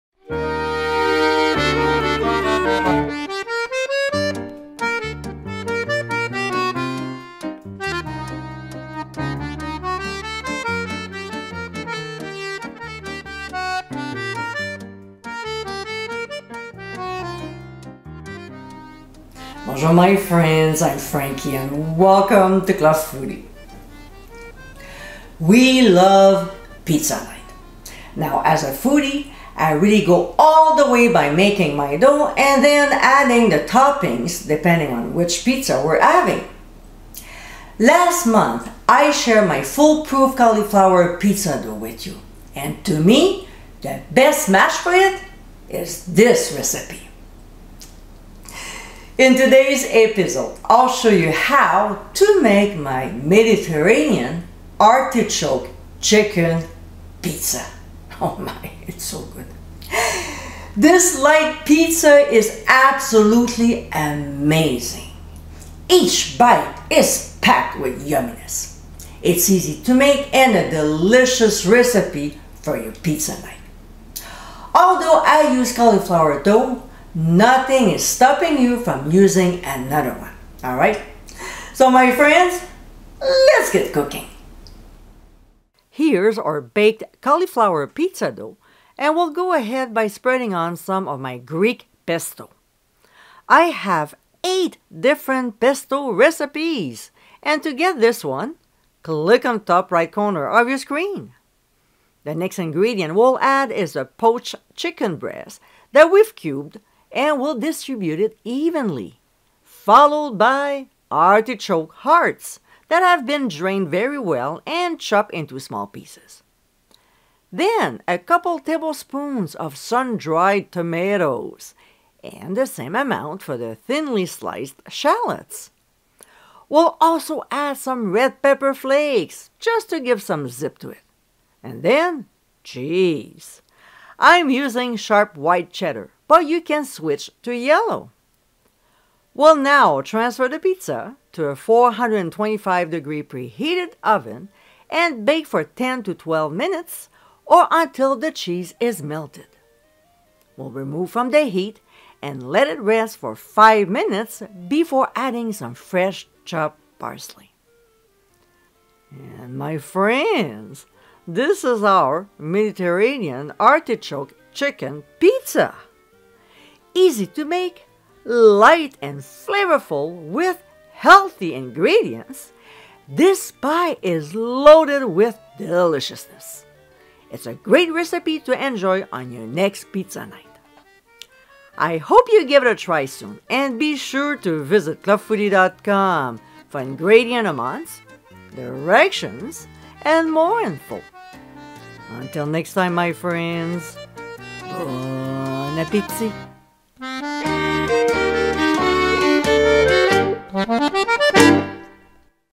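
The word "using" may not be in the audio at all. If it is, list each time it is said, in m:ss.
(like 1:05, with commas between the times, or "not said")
1:19, 2:14.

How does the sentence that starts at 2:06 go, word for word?
We'll also add some red pepper flakes just to give some zip to it.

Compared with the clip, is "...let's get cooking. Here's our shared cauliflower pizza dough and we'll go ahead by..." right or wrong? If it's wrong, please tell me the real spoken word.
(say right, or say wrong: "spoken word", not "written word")
wrong: "baked", not "shared".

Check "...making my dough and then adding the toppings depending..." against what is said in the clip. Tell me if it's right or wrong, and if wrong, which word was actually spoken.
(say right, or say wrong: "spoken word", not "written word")
right.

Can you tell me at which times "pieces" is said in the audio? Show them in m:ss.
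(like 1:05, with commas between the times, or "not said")
1:55.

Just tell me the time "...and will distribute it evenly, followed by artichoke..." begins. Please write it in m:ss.
1:47.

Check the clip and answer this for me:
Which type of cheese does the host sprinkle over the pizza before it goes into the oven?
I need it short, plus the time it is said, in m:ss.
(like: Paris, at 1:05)
sharp white cheddar, at 2:14.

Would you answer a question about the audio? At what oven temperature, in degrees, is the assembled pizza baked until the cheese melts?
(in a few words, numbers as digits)
425.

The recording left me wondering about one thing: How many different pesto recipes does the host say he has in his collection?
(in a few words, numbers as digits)
8.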